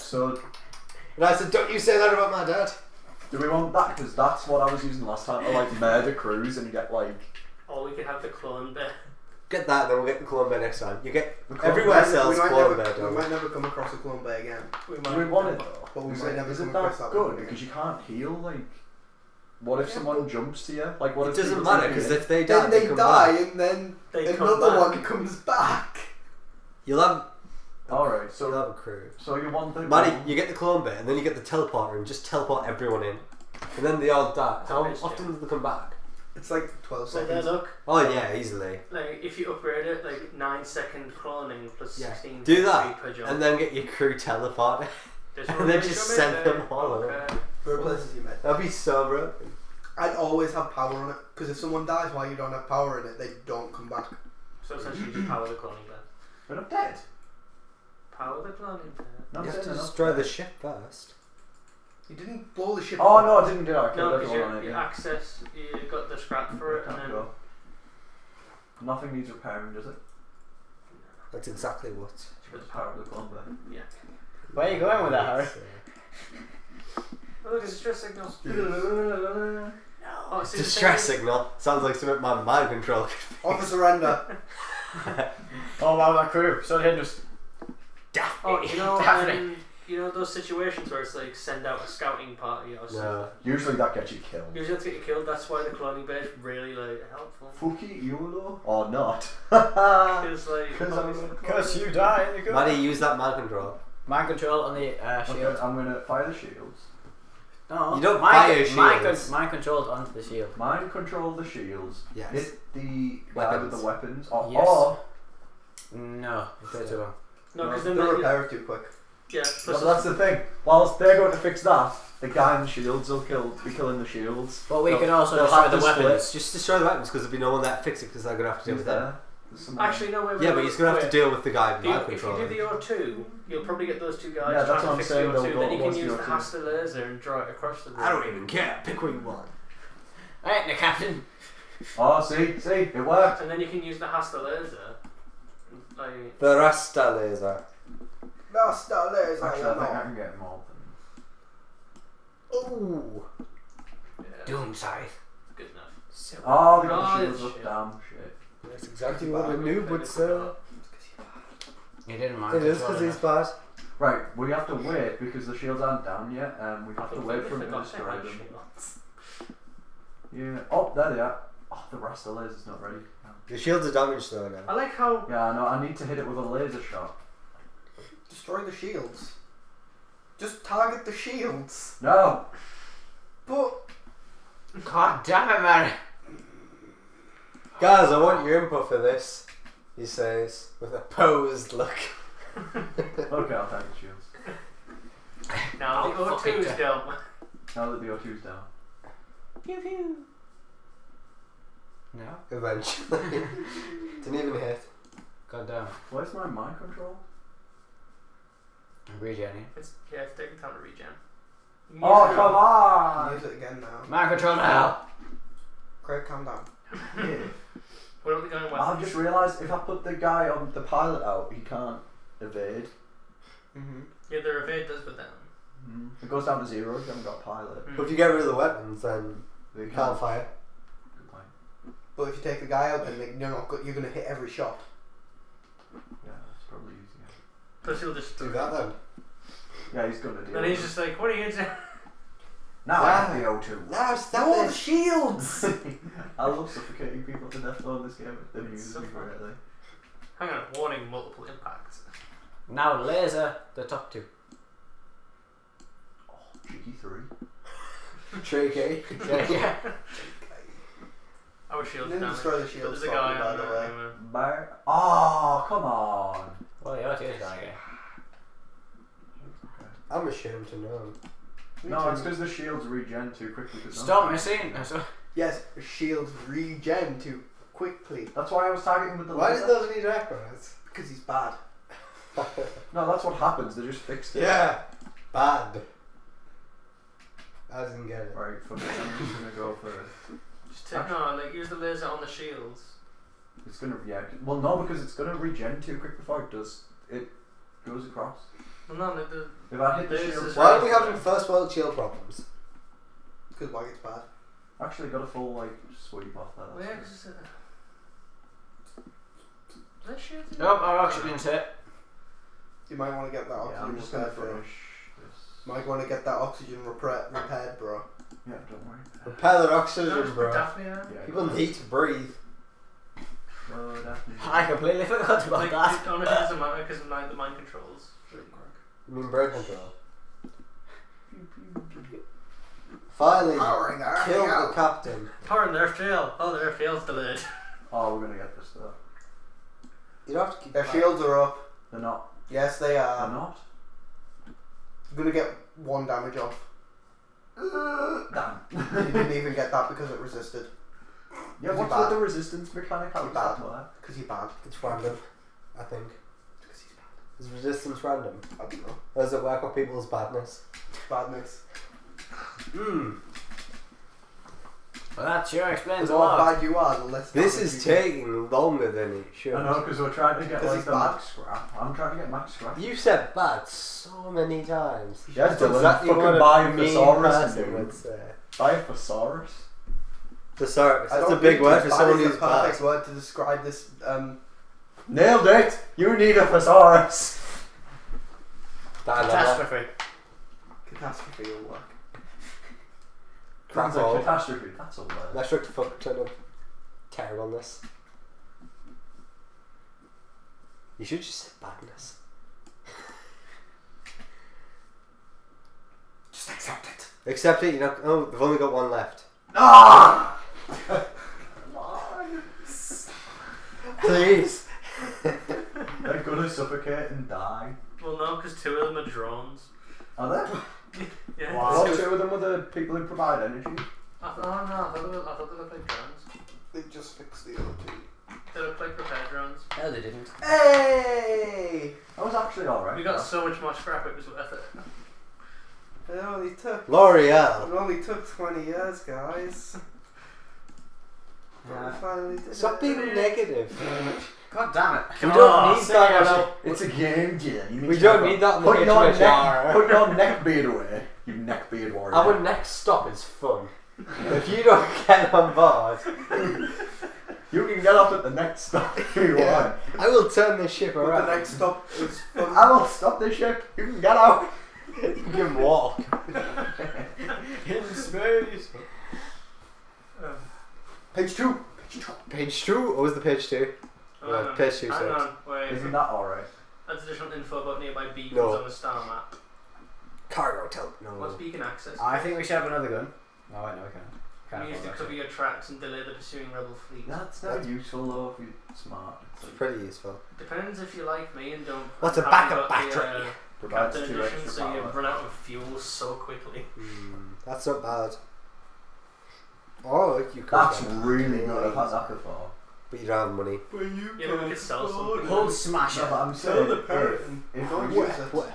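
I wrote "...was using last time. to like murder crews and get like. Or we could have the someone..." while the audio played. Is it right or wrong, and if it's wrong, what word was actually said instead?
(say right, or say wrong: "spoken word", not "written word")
wrong: "clone", not "someone".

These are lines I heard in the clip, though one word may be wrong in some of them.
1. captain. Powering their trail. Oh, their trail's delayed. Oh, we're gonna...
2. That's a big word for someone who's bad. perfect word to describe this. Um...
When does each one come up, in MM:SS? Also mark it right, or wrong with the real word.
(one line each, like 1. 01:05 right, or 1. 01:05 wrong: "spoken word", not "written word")
1. 05:34 right
2. 06:21 right.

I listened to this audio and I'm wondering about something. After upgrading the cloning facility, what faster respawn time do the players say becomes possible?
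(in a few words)
9 seconds.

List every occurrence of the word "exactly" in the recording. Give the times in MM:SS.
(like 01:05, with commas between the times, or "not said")
01:11, 02:38.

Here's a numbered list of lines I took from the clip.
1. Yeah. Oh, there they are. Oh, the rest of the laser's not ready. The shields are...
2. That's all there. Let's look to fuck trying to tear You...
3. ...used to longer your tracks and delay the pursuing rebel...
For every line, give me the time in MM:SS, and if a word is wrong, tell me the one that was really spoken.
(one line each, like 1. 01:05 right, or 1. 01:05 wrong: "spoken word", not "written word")
1. 02:50 right
2. 06:34 right
3. 08:04 wrong: "cover", not "longer".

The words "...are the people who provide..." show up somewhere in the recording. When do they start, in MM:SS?
07:02.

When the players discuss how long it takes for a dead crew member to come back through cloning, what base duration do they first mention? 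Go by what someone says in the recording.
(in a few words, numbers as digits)
12 seconds.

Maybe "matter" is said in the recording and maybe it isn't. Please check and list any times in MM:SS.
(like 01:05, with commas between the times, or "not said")
00:21, 05:26.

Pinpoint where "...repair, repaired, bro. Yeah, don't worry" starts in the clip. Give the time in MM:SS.
05:16.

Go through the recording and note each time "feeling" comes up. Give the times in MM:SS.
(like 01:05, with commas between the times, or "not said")
not said.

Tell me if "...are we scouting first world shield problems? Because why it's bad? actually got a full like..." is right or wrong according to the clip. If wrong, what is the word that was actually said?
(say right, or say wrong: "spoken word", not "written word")
wrong: "having", not "scouting".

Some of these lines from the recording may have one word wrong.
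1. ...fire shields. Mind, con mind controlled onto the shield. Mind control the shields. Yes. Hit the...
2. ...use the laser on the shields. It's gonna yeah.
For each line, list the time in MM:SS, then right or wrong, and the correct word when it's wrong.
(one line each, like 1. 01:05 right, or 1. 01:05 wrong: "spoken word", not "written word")
1. 01:48 right
2. 04:51 right.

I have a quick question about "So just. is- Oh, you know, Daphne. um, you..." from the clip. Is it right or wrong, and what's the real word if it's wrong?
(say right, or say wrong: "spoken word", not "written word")
right.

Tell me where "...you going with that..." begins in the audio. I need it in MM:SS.
01:14.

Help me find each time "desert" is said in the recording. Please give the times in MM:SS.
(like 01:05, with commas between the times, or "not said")
not said.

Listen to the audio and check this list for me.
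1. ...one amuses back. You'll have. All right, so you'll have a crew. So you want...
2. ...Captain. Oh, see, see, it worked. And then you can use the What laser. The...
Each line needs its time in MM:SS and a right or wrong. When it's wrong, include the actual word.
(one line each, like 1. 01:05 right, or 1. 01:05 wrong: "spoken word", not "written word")
1. 00:24 wrong: "comes", not "amuses"
2. 02:20 wrong: "Hasta", not "What".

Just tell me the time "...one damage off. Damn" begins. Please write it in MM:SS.
05:45.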